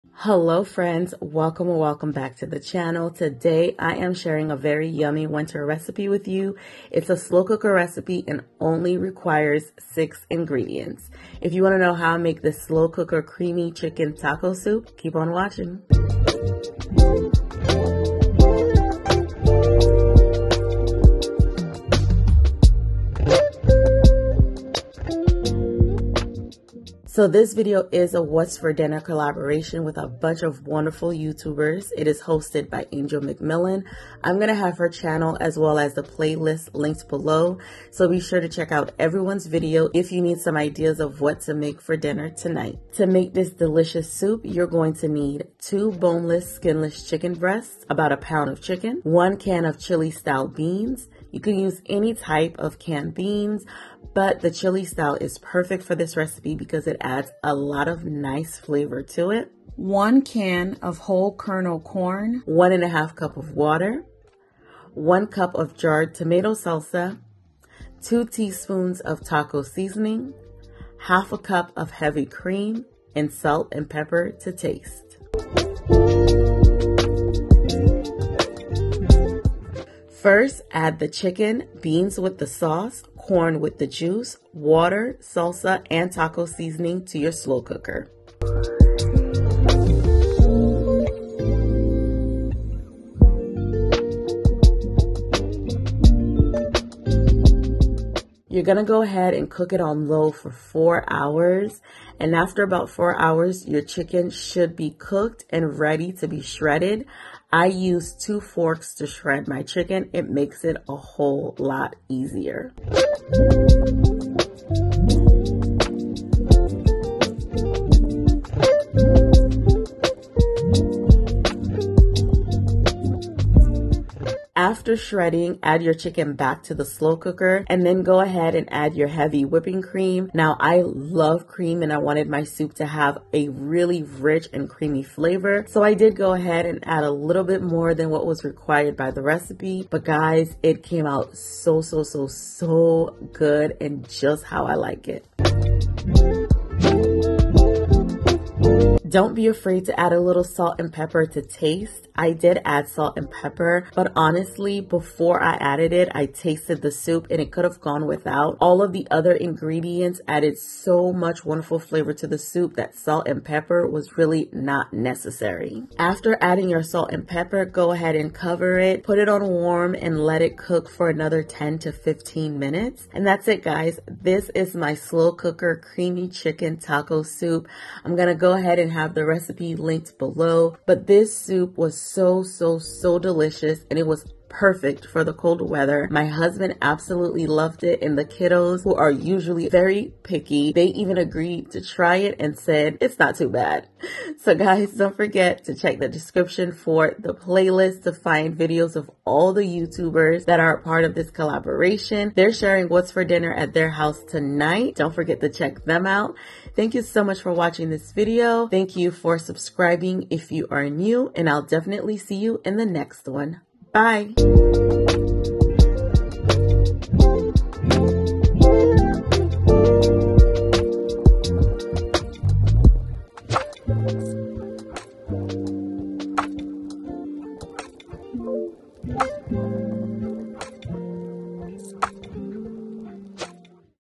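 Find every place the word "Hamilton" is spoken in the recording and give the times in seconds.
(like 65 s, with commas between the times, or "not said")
not said.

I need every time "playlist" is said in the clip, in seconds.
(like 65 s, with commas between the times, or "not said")
36 s, 197 s.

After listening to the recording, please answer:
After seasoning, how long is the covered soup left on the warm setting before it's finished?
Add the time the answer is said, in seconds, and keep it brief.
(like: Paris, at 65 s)
10 to 15 minutes, at 171 s.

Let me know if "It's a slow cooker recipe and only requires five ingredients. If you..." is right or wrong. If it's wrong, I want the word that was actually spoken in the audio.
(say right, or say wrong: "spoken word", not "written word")
wrong: "six", not "five".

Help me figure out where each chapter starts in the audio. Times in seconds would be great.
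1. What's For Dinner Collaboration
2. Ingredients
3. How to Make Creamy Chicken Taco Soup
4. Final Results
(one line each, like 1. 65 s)
1. 27 s
2. 43 s
3. 75 s
4. 172 s.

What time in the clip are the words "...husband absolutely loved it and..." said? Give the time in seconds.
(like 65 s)
186 s.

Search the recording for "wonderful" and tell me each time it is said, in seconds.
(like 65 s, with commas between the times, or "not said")
30 s, 161 s.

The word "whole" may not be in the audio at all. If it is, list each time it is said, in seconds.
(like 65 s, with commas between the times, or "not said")
60 s, 110 s.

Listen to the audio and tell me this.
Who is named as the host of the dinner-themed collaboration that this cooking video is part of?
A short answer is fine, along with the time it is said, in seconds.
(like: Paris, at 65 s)
Angel McMillan, at 32 s.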